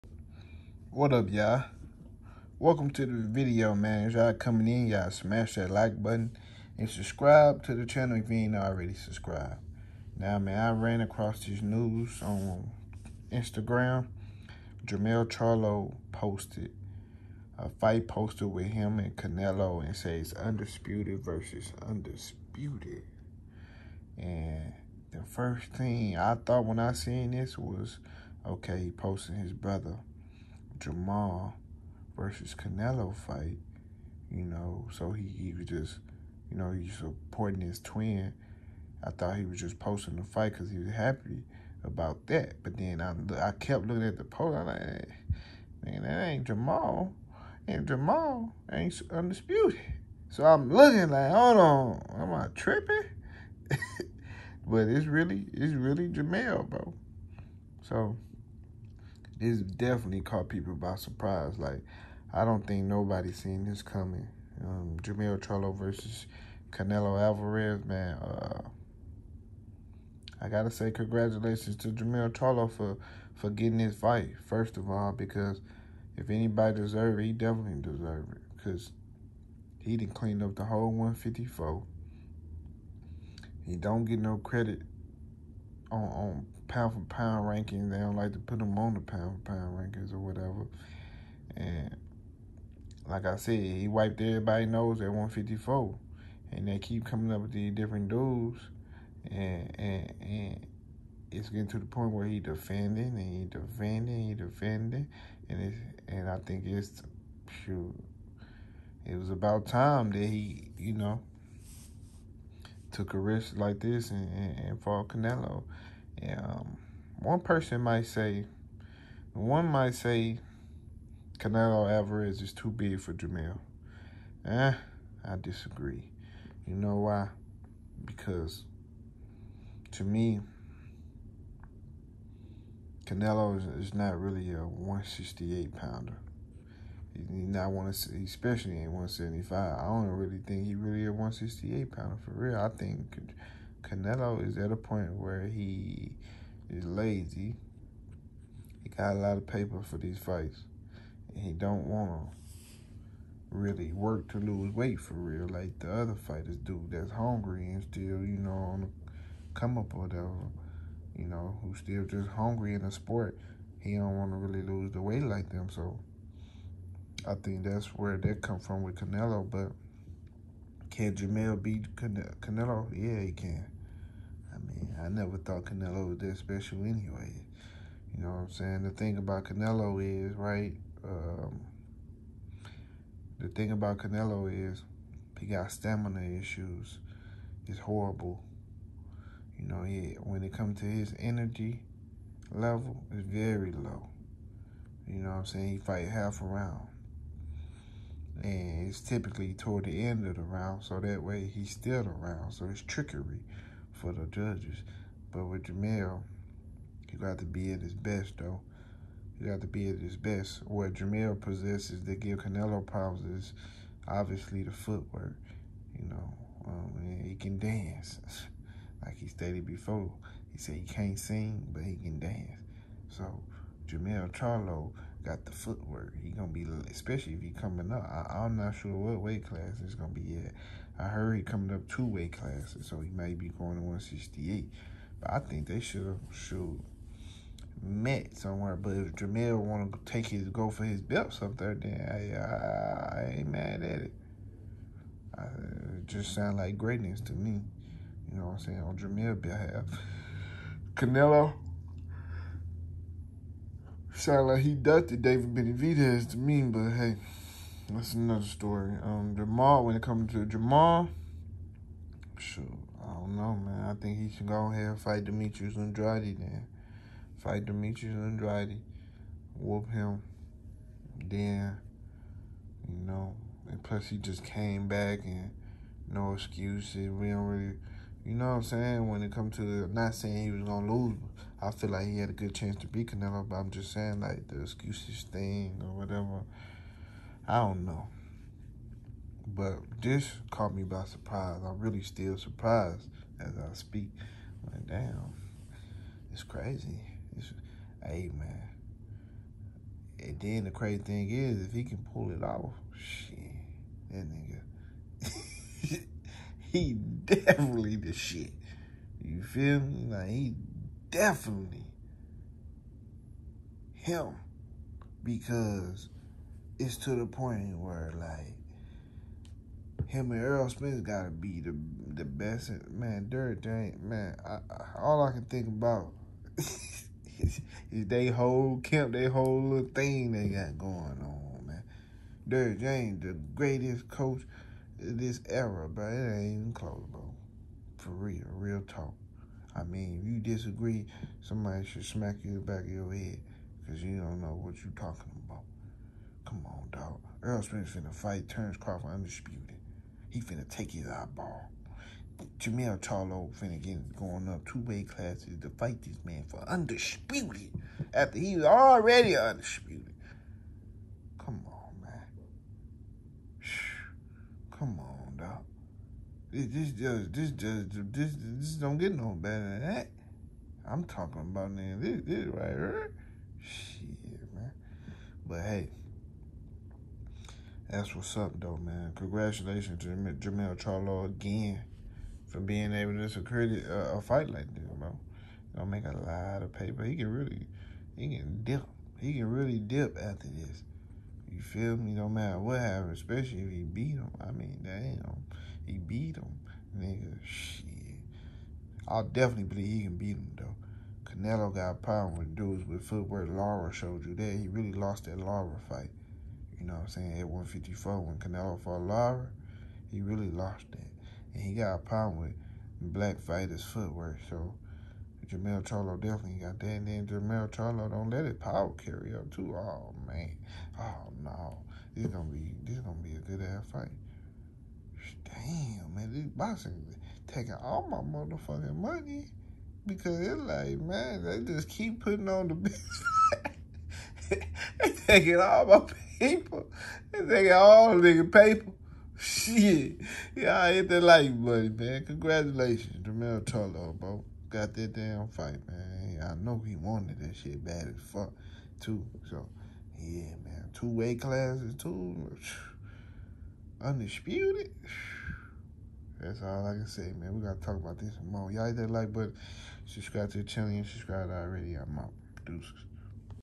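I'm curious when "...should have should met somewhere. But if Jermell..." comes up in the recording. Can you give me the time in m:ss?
3:55.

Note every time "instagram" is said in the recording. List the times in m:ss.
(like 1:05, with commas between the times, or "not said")
0:13.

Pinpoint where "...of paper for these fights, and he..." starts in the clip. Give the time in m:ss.
2:29.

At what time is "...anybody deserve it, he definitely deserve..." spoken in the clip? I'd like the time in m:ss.
1:16.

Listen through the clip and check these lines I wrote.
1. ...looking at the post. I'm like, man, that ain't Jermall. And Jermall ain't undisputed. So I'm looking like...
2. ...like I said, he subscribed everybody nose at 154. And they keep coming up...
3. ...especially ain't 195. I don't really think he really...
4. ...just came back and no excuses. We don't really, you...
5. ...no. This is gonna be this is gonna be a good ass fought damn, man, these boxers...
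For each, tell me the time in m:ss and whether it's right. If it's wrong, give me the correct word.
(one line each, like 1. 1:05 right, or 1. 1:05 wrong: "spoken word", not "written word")
1. 0:43 right
2. 1:33 wrong: "wiped", not "subscribed"
3. 2:17 wrong: "175", not "195"
4. 4:34 right
5. 7:01 wrong: "fight", not "fought".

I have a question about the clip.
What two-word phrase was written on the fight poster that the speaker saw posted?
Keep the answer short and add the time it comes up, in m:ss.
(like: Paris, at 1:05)
Undisputed versus undisputed, at 0:20.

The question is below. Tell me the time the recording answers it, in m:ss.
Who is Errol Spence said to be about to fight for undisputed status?
5:48.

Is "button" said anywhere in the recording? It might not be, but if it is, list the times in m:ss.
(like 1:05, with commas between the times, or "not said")
0:06, 7:39.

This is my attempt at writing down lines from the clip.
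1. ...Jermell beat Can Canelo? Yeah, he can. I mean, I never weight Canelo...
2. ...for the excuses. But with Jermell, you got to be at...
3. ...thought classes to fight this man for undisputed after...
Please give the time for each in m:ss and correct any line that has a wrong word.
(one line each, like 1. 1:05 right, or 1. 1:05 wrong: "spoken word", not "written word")
1. 2:51 wrong: "thought", not "weight"
2. 3:23 wrong: "judges", not "excuses"
3. 5:54 wrong: "weight", not "thought".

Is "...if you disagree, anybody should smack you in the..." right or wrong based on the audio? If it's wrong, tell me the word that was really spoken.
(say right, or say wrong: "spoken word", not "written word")
wrong: "somebody", not "anybody".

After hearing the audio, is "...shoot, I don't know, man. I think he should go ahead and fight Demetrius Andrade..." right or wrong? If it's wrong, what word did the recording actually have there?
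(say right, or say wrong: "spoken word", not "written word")
right.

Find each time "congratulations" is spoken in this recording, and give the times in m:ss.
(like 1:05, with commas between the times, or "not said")
1:10, 6:19, 7:22.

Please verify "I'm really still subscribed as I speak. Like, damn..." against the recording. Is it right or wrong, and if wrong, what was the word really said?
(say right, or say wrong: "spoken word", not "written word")
wrong: "surprised", not "subscribed".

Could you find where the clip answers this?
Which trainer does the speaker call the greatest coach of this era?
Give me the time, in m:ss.
5:32.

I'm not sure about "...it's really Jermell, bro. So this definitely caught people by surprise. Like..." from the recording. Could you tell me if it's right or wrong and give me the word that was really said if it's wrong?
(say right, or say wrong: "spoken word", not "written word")
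right.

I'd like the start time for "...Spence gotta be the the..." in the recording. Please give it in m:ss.
5:20.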